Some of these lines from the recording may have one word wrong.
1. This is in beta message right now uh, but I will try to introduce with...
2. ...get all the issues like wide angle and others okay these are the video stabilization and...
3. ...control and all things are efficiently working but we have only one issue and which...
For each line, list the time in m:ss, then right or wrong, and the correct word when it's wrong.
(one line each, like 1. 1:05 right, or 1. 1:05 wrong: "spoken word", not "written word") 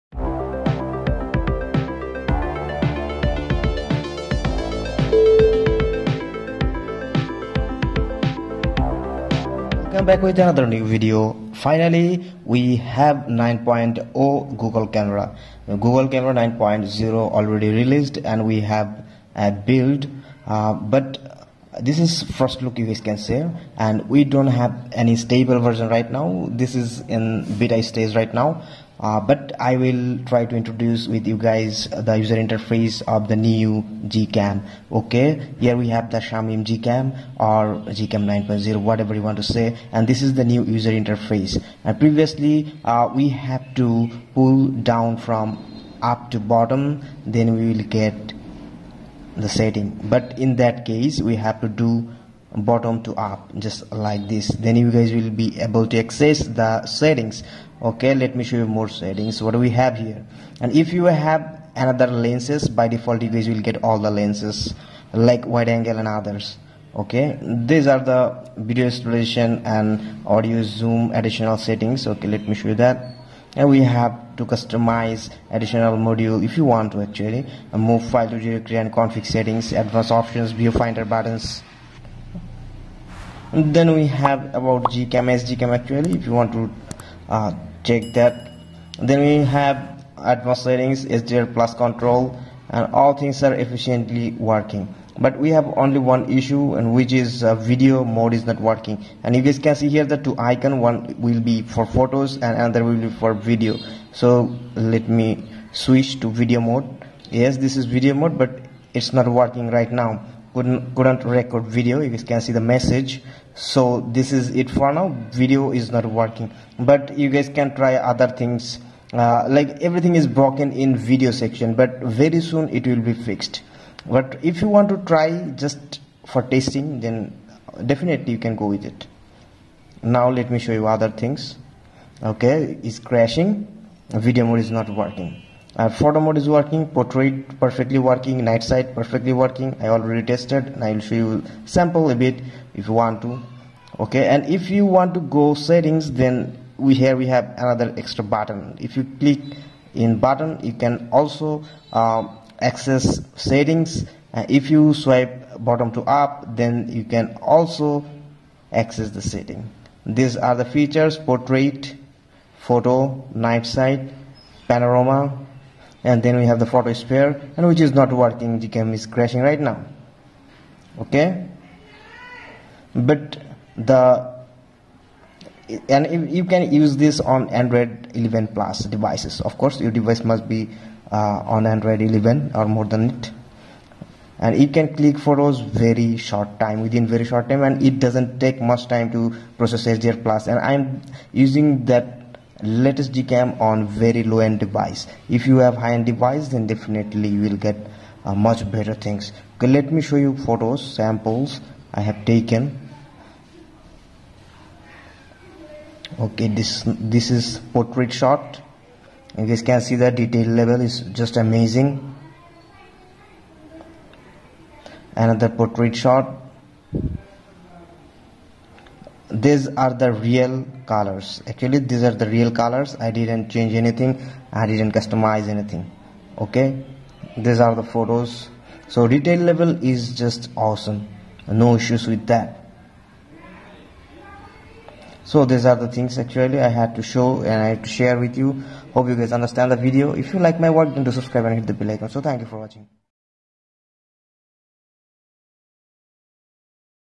1. 0:26 wrong: "stage", not "message"
2. 1:03 wrong: "lenses", not "issues"
3. 1:31 right.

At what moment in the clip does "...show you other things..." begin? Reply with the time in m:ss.
2:10.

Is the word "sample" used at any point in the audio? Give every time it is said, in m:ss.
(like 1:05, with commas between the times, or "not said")
2:21, 3:20.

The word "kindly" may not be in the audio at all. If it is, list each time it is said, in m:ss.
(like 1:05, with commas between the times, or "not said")
not said.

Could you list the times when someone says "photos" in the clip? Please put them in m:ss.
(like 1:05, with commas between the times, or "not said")
1:41, 2:15, 2:42, 2:46, 3:05, 3:20, 3:47.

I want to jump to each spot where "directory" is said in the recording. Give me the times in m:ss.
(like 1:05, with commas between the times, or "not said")
1:18.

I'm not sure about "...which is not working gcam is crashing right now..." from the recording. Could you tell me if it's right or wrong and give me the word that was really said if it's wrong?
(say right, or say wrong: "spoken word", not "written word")
right.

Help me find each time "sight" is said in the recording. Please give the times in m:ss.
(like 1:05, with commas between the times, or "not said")
2:18, 2:43.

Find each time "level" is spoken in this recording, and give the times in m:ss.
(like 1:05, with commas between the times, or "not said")
3:30, 3:49.